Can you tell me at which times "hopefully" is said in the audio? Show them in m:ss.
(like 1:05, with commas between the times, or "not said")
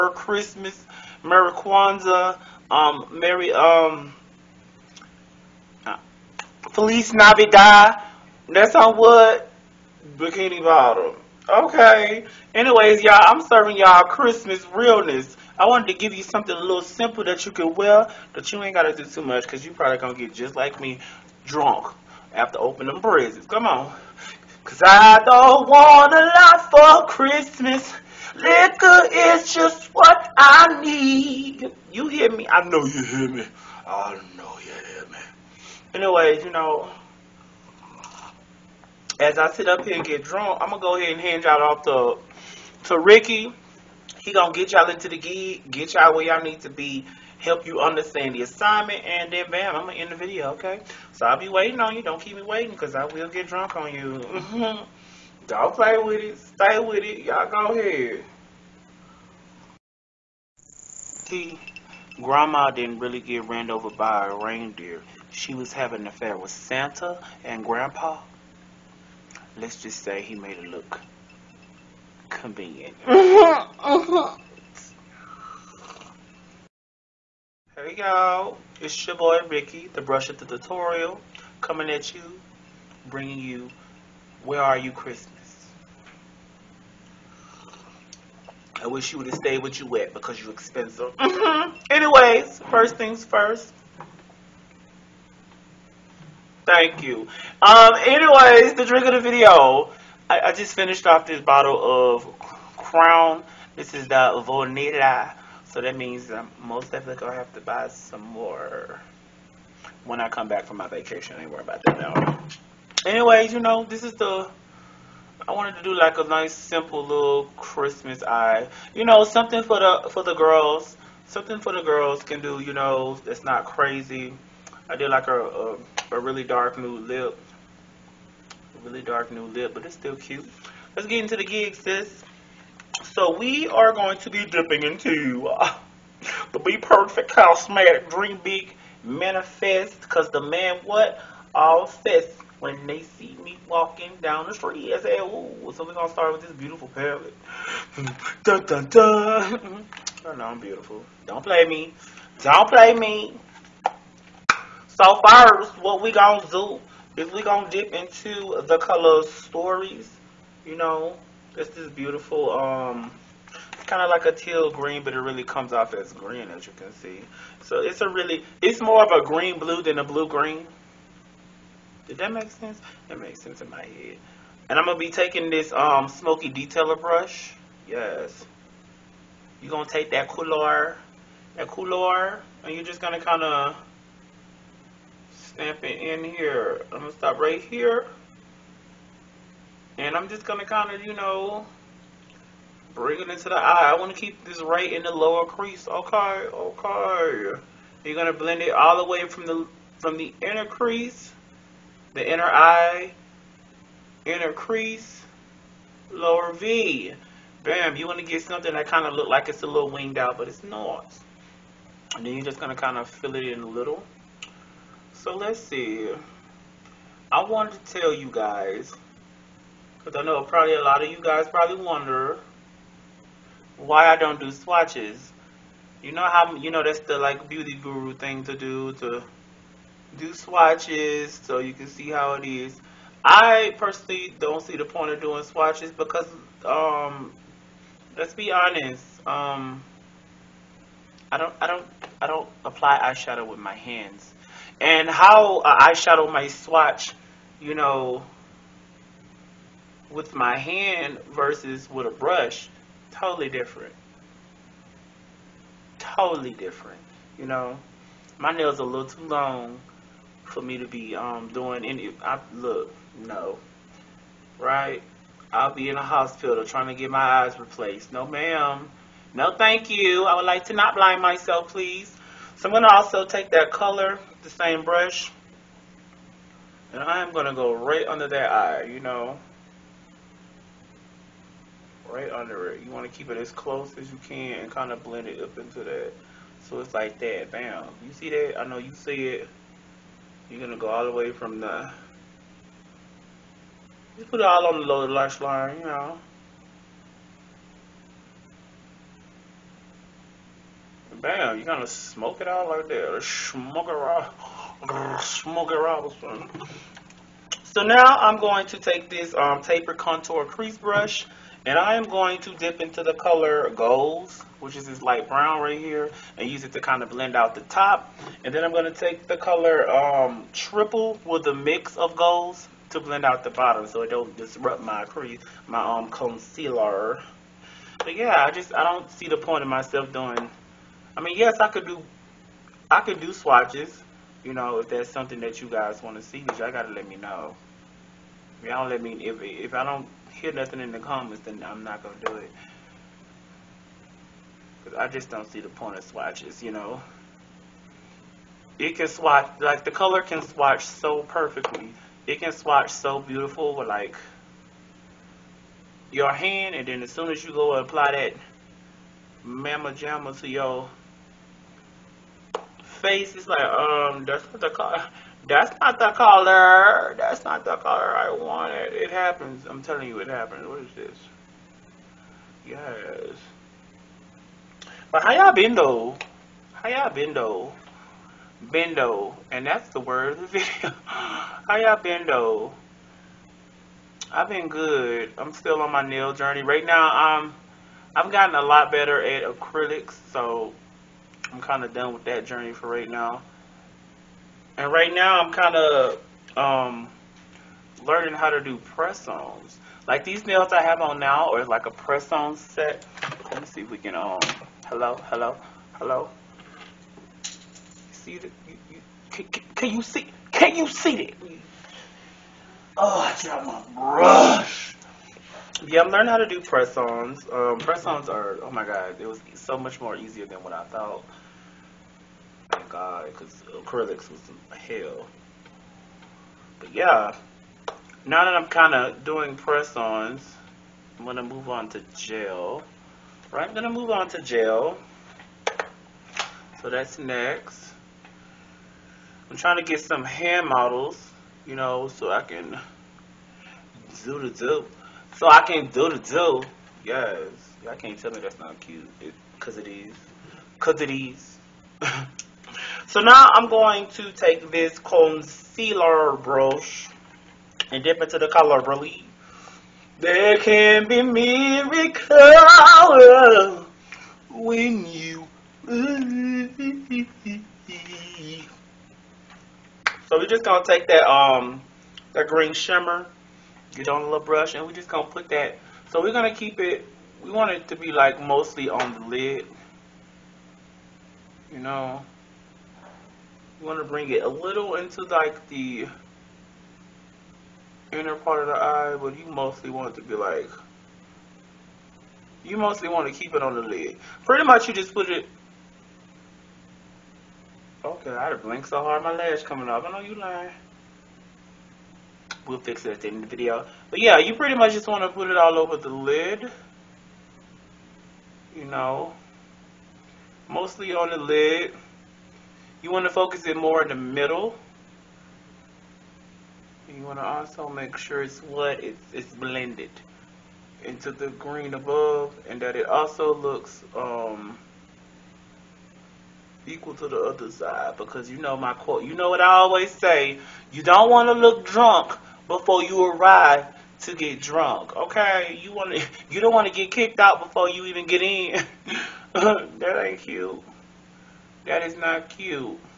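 not said.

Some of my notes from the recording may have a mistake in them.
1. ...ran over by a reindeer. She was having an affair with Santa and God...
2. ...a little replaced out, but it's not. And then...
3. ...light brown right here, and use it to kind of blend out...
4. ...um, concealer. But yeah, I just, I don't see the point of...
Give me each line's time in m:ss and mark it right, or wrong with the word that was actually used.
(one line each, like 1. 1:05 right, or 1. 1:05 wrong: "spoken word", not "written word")
1. 1:03 wrong: "Grandpa", not "God"
2. 3:29 wrong: "winged", not "replaced"
3. 5:15 right
4. 5:25 right.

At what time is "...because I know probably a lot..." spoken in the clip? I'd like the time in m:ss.
3:39.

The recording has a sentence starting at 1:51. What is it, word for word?
I ain't worried about that now.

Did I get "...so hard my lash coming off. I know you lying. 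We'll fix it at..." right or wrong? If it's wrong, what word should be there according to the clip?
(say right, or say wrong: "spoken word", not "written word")
right.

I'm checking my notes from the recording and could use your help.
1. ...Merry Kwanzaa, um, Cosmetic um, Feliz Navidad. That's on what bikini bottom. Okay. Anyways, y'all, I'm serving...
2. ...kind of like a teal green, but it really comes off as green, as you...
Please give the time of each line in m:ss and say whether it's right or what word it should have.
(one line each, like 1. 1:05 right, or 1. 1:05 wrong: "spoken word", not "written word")
1. 0:01 wrong: "Merry", not "Cosmetic"
2. 2:43 right.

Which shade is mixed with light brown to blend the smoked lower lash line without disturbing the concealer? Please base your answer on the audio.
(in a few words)
Triple.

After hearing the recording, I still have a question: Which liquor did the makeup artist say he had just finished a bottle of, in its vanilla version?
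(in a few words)
Crown.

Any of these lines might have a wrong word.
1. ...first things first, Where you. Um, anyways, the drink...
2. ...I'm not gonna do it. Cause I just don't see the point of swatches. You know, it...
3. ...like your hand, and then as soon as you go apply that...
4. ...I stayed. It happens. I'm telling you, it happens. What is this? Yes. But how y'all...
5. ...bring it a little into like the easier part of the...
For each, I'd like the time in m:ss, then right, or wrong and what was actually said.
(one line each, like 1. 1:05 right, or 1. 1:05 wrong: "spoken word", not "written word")
1. 1:32 wrong: "Thank", not "Where"
2. 5:41 right
3. 5:53 right
4. 6:08 wrong: "wanted", not "stayed"
5. 8:04 wrong: "inner", not "easier".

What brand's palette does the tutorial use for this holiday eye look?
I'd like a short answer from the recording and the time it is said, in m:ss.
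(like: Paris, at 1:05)
BPerfect Cosmetic, at 2:16.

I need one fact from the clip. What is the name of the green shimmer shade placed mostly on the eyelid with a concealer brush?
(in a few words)
Relief.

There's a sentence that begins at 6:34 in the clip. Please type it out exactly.
And right now, I'm kind of um, learning how to do press-ons.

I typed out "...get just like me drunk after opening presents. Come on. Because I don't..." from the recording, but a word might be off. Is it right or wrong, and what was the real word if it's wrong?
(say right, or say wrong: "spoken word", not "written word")
right.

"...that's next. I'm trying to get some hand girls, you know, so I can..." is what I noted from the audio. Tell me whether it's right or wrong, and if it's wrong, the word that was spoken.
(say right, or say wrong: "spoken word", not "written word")
wrong: "models", not "girls".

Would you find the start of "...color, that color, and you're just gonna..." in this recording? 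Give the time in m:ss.
3:00.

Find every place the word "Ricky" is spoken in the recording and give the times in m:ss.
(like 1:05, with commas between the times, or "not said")
0:42, 1:19.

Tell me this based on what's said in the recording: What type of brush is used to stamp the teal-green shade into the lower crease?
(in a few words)
Smoky detailer brush.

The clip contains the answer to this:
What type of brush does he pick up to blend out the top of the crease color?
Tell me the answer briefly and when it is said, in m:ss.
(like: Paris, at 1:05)
Contour crease brush, at 5:09.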